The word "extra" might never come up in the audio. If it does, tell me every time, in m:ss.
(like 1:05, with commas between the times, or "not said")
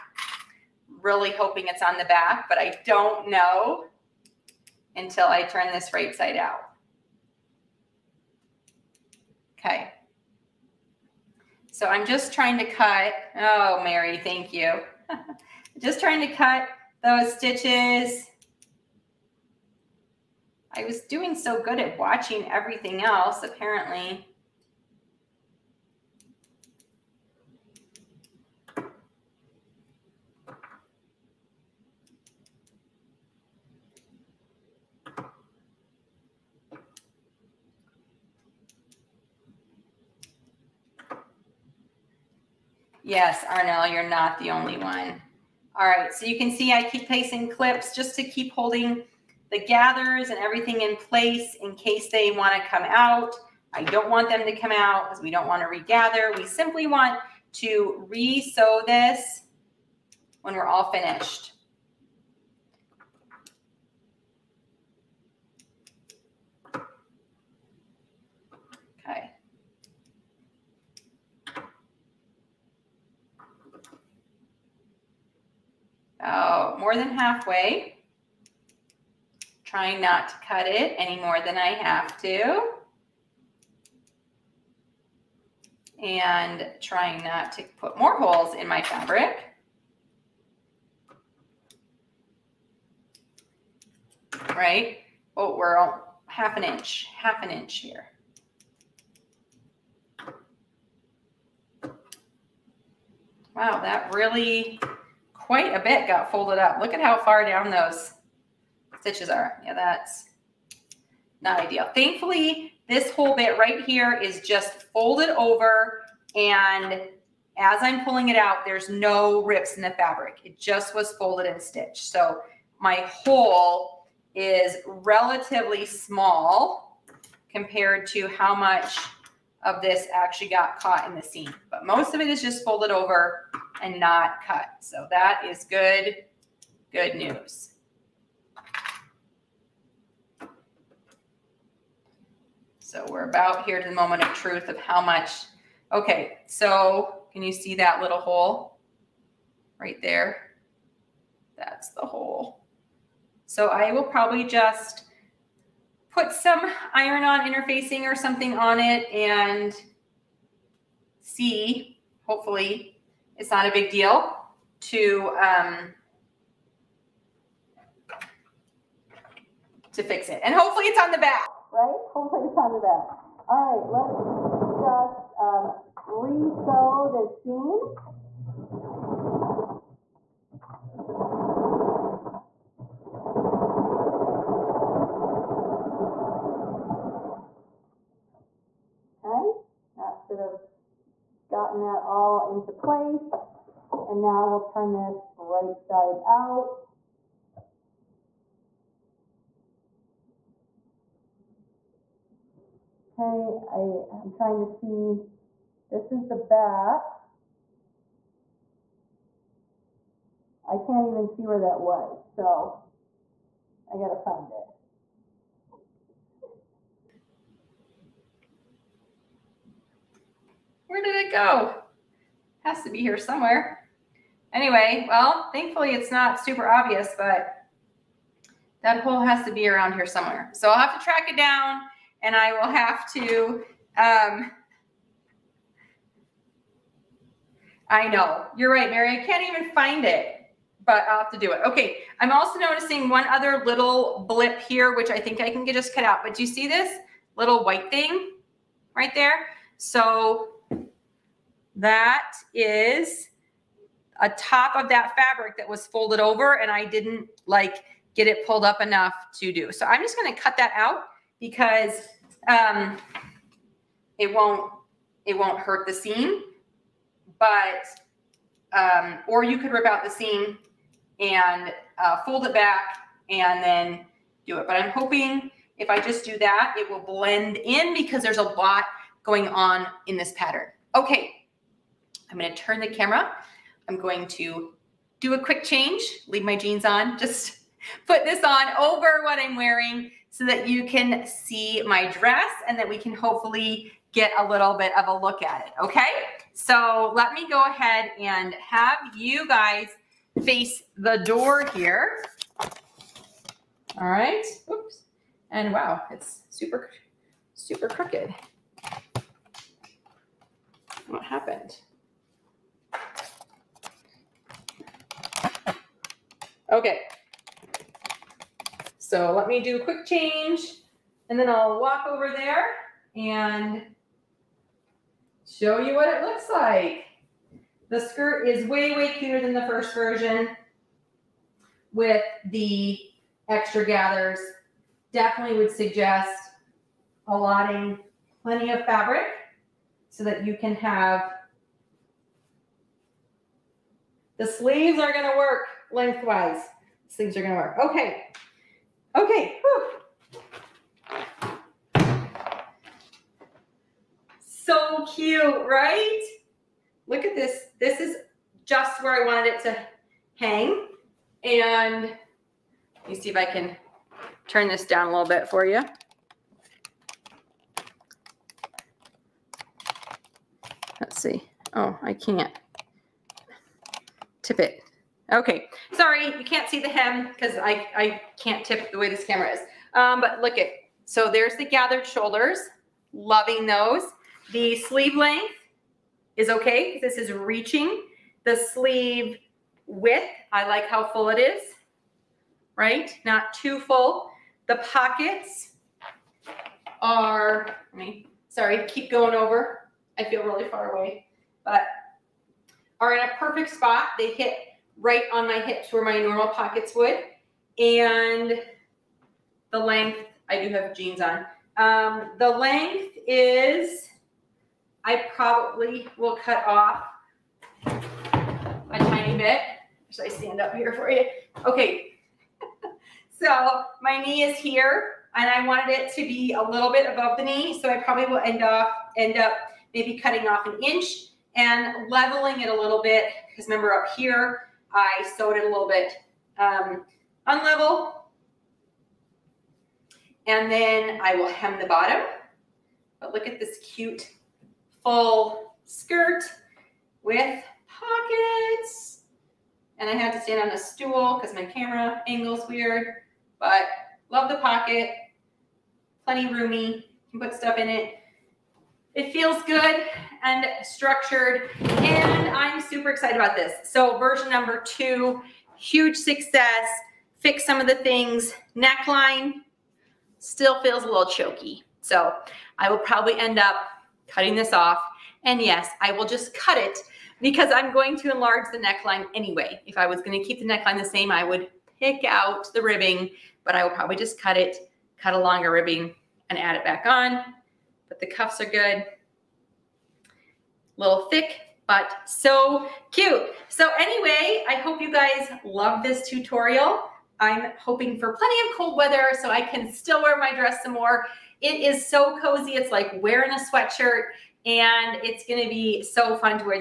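5:33.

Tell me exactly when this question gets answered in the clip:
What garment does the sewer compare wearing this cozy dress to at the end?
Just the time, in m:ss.
8:23.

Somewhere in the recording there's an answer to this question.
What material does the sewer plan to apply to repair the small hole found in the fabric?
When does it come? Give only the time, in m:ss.
2:36.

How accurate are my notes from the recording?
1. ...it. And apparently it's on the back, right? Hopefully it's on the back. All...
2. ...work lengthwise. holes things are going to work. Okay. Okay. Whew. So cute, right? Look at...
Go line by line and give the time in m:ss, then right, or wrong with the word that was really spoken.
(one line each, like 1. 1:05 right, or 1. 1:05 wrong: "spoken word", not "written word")
1. 2:50 wrong: "hopefully", not "apparently"
2. 5:45 wrong: "sleeves", not "holes".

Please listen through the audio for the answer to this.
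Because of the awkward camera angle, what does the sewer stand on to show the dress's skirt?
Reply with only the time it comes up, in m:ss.
7:30.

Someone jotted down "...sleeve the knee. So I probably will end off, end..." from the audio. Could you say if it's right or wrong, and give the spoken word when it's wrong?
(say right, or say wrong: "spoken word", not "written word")
wrong: "above", not "sleeve".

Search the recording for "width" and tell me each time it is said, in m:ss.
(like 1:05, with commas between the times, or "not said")
6:29.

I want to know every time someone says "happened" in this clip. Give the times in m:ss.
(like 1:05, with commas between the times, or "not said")
5:11.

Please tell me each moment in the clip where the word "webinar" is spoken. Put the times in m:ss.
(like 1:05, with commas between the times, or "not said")
not said.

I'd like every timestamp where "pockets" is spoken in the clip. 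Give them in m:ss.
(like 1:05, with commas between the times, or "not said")
6:34, 6:46, 7:27, 7:34.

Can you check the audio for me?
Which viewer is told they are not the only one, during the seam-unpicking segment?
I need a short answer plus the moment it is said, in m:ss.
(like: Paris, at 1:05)
Arnell, at 0:43.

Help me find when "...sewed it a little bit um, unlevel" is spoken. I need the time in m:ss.
7:15.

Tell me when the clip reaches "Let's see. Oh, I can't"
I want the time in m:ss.
6:10.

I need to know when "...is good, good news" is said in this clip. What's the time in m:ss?
2:15.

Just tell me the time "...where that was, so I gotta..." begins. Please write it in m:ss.
3:31.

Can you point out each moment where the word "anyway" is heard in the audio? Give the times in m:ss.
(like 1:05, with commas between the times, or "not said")
3:44, 7:59, 8:13.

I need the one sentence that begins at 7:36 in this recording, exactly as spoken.
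Plenty roomy, you can put stuff in it.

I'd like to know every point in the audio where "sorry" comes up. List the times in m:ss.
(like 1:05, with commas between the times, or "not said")
6:15, 6:38.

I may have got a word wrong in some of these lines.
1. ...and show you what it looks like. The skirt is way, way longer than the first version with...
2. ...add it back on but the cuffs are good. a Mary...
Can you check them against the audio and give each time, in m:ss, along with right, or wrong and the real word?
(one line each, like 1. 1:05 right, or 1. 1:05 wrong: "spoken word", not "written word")
1. 5:23 wrong: "cuter", not "longer"
2. 8:06 wrong: "Little", not "Mary".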